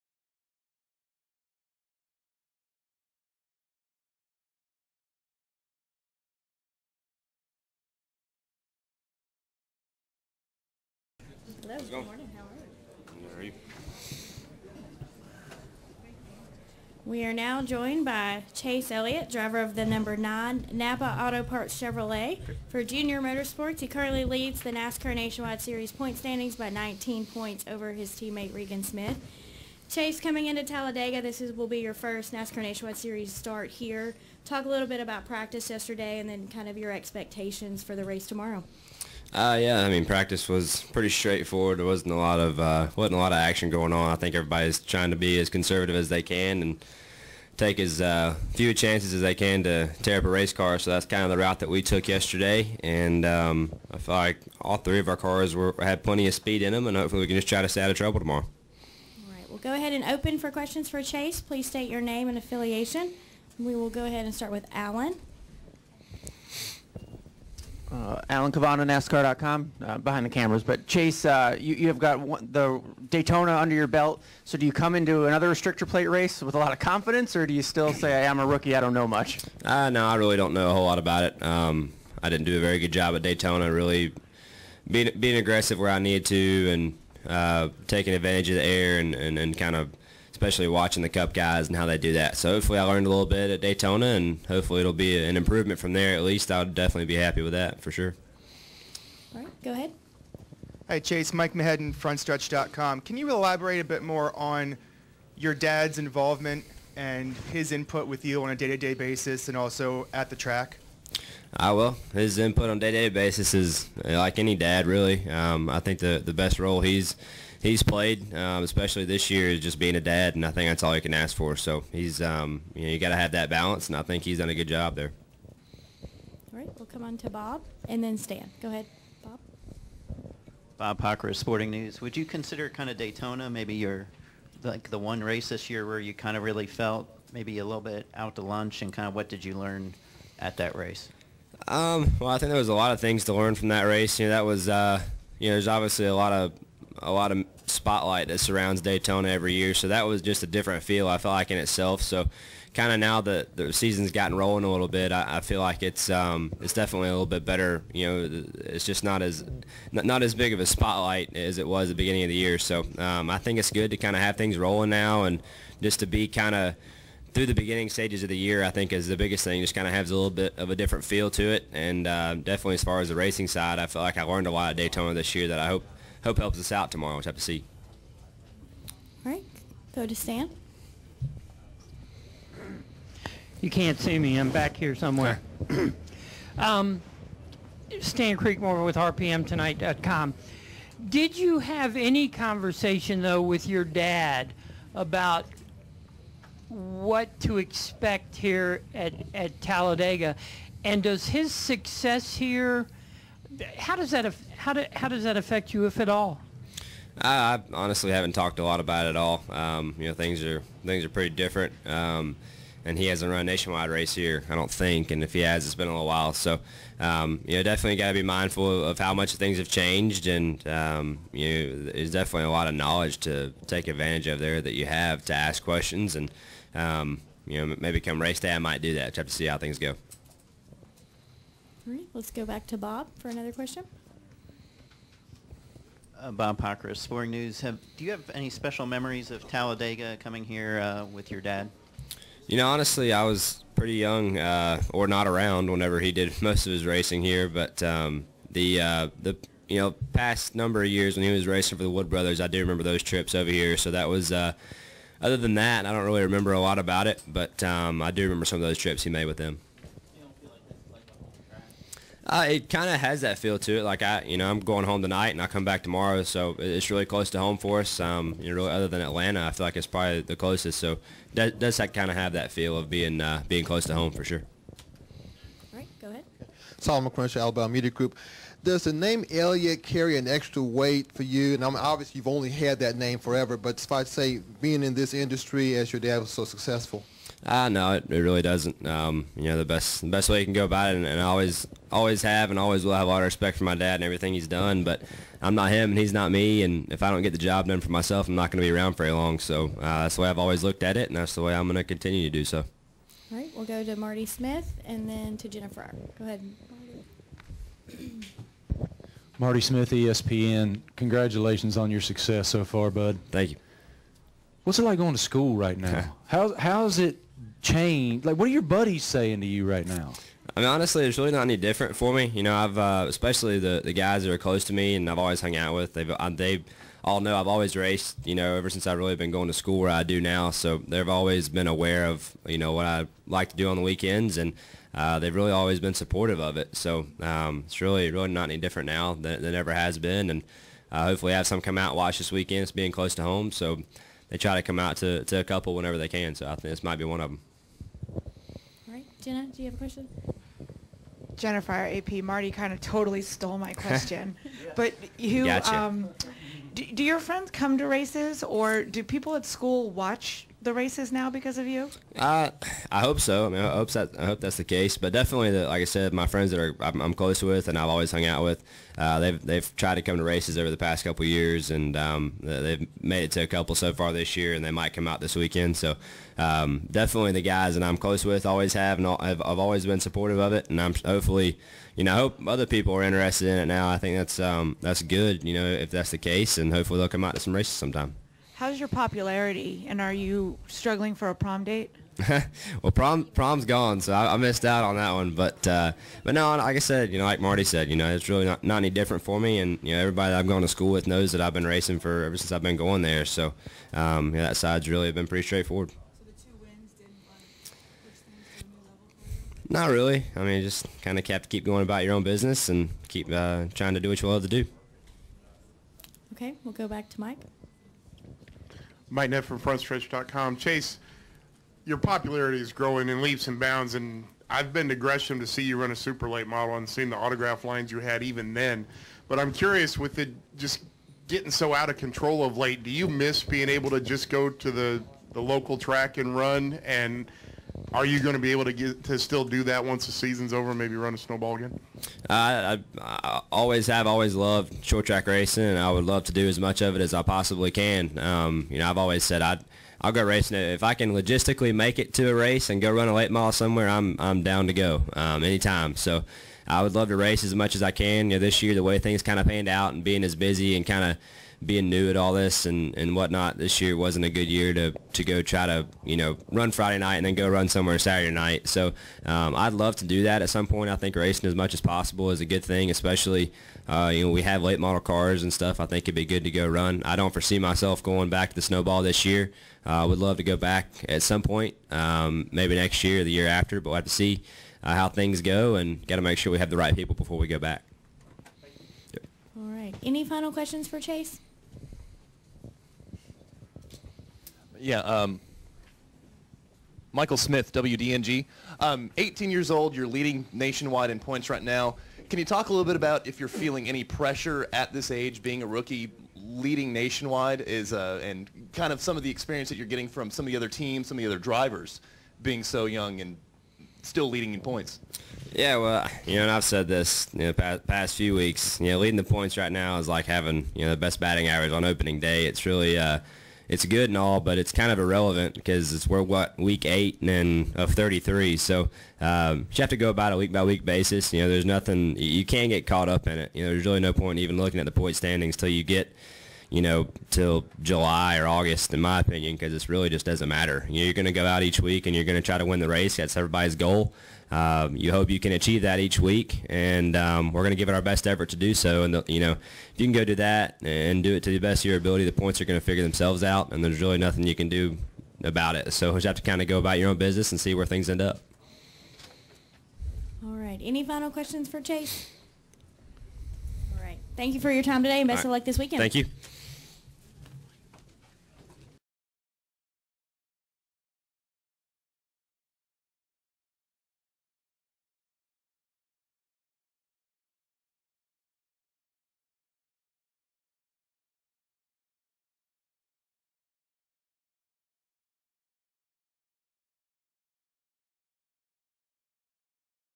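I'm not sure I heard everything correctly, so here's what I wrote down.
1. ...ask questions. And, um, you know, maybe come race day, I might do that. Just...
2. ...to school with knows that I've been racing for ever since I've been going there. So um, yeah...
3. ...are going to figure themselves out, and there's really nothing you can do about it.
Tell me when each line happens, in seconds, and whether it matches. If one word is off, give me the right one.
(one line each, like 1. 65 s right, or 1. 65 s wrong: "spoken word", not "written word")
1. 225 s right
2. 400 s right
3. 552 s right.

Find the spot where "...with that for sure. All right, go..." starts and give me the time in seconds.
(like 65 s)
97 s.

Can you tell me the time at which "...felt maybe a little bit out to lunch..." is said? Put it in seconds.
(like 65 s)
136 s.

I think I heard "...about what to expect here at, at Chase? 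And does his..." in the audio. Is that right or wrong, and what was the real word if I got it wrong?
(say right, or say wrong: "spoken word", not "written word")
wrong: "Talladega", not "Chase".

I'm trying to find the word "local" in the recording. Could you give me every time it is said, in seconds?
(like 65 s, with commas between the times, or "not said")
435 s.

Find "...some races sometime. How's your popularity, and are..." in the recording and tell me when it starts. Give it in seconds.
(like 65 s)
387 s.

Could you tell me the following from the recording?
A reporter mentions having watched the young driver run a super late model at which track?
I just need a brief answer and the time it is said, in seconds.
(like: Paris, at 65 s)
Gresham, at 424 s.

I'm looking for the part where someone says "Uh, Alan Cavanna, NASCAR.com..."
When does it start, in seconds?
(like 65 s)
67 s.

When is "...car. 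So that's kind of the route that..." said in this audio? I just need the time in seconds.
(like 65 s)
50 s.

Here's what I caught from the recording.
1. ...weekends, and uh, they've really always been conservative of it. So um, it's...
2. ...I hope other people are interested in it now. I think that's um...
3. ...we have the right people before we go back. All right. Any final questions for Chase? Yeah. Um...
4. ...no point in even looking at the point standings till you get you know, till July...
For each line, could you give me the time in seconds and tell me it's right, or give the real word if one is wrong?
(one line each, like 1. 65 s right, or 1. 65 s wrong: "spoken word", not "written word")
1. 333 s wrong: "supportive", not "conservative"
2. 382 s right
3. 486 s right
4. 533 s right.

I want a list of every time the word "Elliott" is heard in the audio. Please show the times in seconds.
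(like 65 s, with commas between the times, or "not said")
18 s, 279 s.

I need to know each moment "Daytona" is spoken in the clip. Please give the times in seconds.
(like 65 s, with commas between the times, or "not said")
73 s, 83 s, 93 s, 132 s, 148 s, 174 s.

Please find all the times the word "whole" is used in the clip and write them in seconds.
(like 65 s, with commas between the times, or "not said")
80 s.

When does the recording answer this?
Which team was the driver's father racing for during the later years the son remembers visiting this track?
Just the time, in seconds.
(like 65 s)
251 s.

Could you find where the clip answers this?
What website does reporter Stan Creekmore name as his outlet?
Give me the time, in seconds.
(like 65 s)
188 s.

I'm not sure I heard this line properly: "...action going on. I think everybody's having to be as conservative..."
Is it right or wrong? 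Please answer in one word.
wrong.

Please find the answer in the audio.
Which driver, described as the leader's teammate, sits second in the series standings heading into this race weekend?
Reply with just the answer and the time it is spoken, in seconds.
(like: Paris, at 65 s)
Regan Smith, at 28 s.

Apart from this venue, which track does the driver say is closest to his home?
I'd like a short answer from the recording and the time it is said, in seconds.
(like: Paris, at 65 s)
Atlanta, at 269 s.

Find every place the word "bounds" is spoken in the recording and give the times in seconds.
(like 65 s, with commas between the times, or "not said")
423 s.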